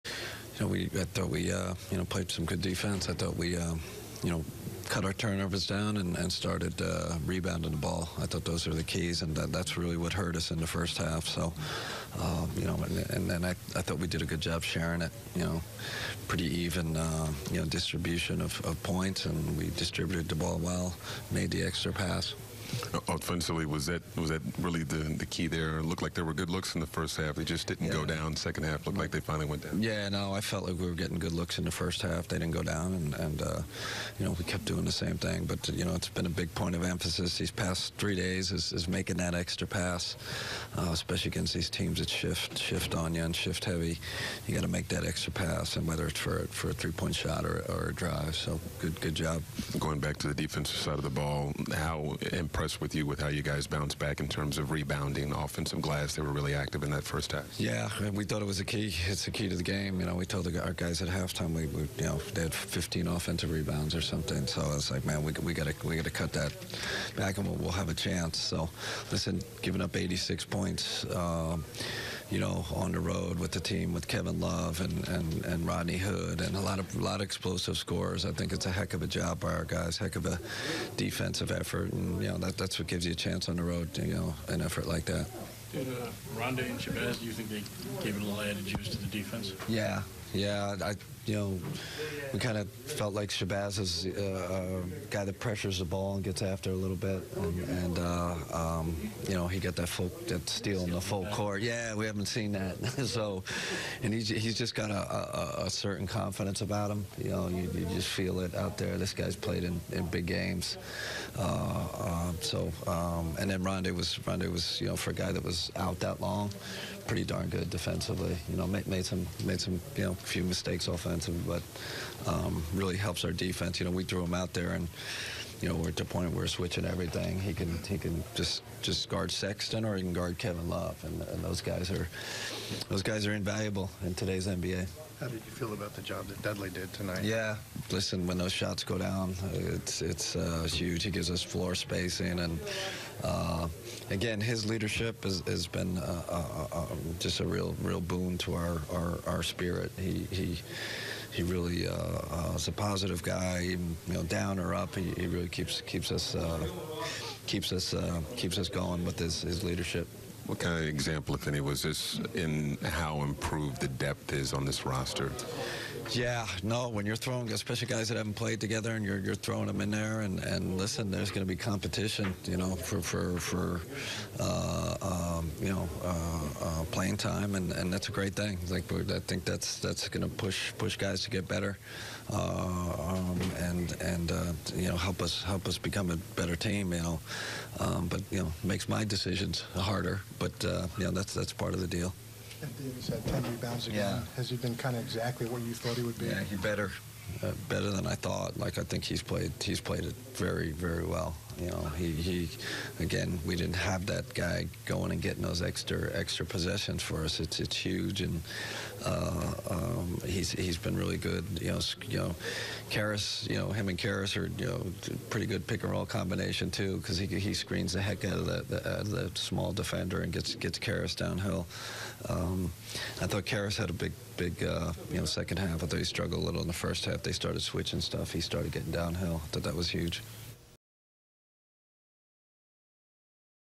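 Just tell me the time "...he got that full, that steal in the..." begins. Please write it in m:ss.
1:39.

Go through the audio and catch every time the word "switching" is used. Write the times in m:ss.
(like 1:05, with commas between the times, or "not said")
2:06, 3:47.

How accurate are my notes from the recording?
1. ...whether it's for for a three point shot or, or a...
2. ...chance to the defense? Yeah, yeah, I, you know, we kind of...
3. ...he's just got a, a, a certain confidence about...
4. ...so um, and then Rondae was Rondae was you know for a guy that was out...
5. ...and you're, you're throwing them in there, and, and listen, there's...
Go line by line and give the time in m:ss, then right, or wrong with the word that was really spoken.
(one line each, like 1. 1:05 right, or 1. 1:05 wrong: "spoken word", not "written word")
1. 0:45 right
2. 1:28 wrong: "juice", not "chance"
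3. 1:44 right
4. 1:52 right
5. 2:48 right.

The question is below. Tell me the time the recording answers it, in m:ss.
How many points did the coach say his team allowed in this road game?
1:09.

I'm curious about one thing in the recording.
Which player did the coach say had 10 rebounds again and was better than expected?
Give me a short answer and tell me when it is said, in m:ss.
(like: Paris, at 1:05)
Davis, at 3:12.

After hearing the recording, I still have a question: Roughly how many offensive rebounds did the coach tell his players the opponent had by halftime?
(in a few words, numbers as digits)
15.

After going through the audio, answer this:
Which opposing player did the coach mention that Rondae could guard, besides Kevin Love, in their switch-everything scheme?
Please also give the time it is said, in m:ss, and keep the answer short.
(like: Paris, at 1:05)
Sexton, at 2:09.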